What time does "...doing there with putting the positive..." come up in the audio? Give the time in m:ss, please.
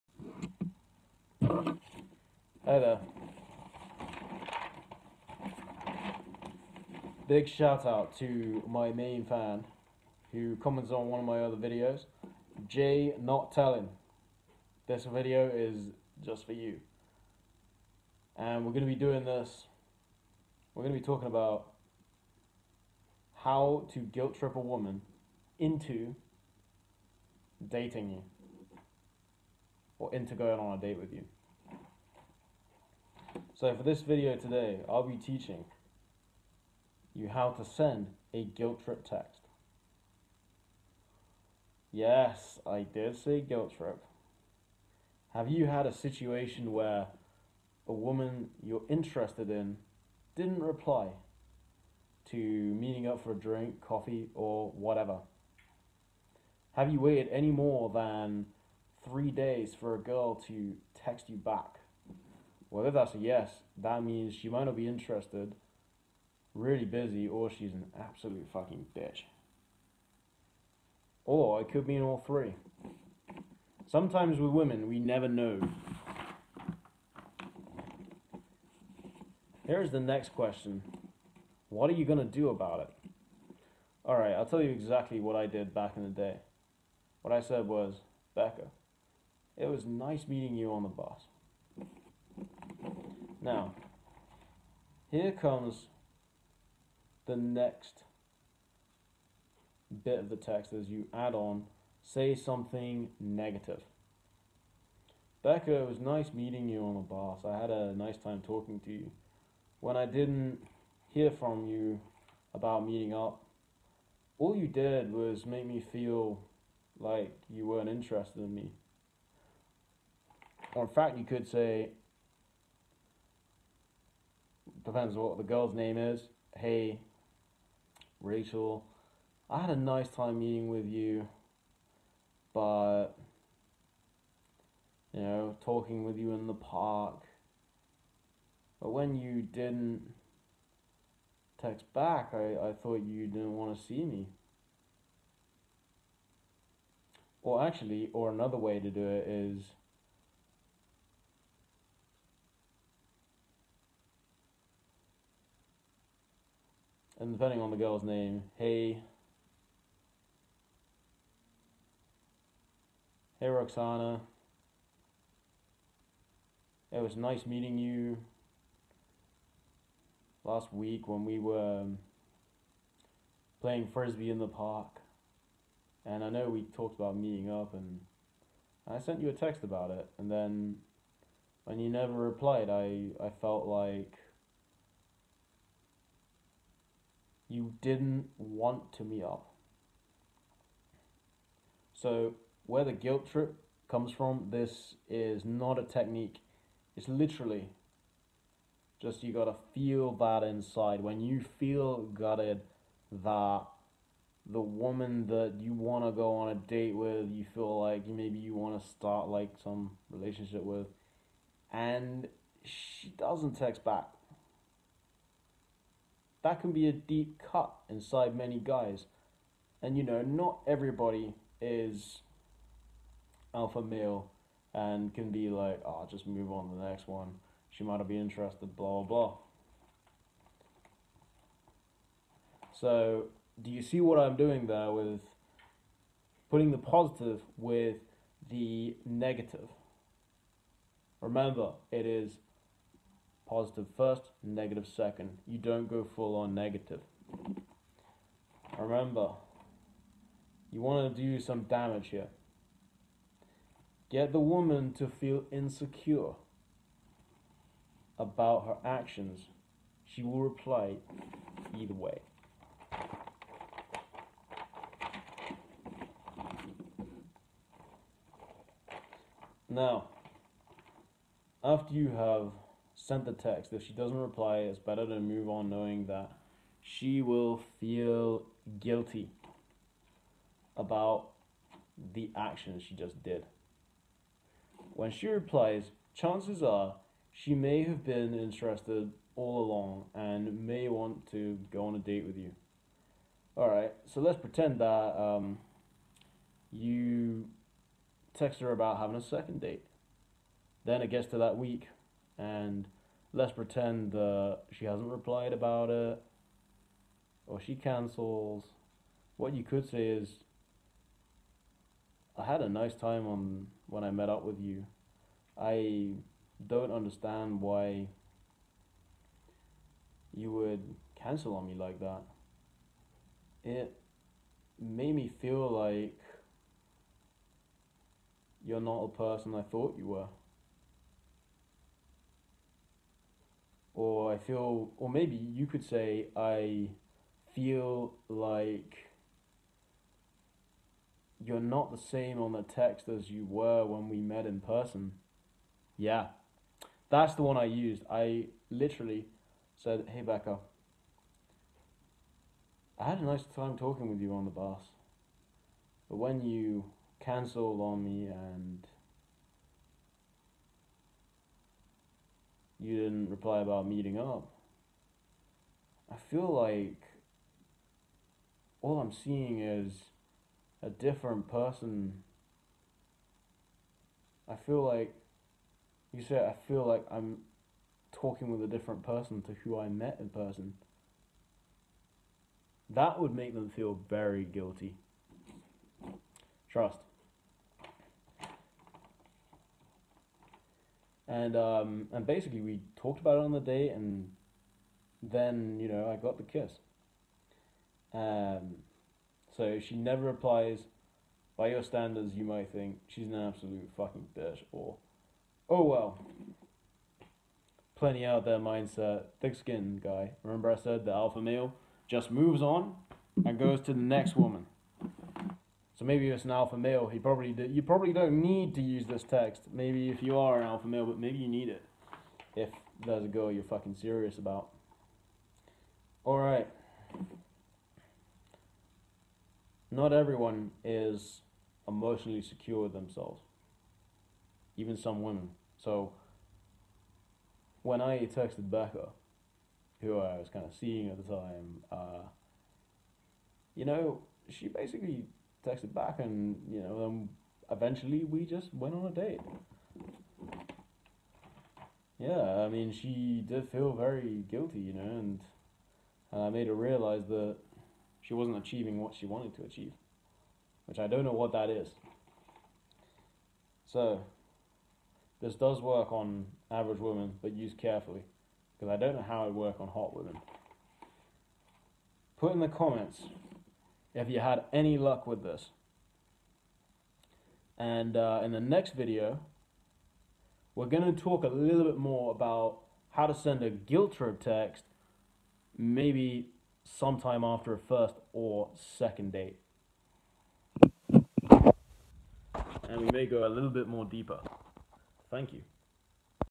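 3:54.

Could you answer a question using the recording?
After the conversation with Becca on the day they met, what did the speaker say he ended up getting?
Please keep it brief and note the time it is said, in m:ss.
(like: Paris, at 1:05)
the kiss, at 6:36.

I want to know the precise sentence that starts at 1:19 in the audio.
Here's the next question What are you going to do about it?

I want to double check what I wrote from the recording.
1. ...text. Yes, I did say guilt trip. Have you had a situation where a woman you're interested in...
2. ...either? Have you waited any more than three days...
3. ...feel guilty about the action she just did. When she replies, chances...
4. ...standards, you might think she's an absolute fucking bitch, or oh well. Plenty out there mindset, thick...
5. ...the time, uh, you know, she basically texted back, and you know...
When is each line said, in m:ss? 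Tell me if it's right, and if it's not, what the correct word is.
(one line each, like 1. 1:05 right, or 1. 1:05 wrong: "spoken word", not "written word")
1. 0:39 right
2. 0:54 wrong: "whatever", not "either"
3. 4:37 right
4. 6:41 right
5. 7:21 right.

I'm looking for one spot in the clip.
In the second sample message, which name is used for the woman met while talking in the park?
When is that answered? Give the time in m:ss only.
2:08.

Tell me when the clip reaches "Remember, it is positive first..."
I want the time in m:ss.
4:01.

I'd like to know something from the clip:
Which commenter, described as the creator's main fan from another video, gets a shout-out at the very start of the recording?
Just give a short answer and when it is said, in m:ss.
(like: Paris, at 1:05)
Jay Not Telling, at 0:12.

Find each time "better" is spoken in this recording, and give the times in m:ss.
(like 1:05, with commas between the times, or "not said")
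4:34.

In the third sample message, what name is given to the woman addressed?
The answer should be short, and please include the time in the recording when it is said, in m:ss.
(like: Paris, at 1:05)
Roxana, at 2:43.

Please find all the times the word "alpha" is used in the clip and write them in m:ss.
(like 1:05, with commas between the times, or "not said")
3:43, 6:51, 6:56, 7:00.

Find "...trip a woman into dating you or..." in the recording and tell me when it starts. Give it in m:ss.
0:24.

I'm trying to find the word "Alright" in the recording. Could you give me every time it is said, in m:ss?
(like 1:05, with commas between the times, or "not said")
1:24, 4:53.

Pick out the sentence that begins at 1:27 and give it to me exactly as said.
What I said was, Becca, it was nice meeting you on the bus.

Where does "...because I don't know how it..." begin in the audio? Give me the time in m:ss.
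7:48.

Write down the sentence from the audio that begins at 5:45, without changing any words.
Yeah, that's the one I used.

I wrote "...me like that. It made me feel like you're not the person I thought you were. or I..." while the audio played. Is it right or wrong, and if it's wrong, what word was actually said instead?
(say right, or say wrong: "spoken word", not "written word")
right.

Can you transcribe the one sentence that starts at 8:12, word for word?
And we may go a little bit more deeper.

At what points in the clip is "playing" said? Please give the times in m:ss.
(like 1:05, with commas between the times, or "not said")
2:53.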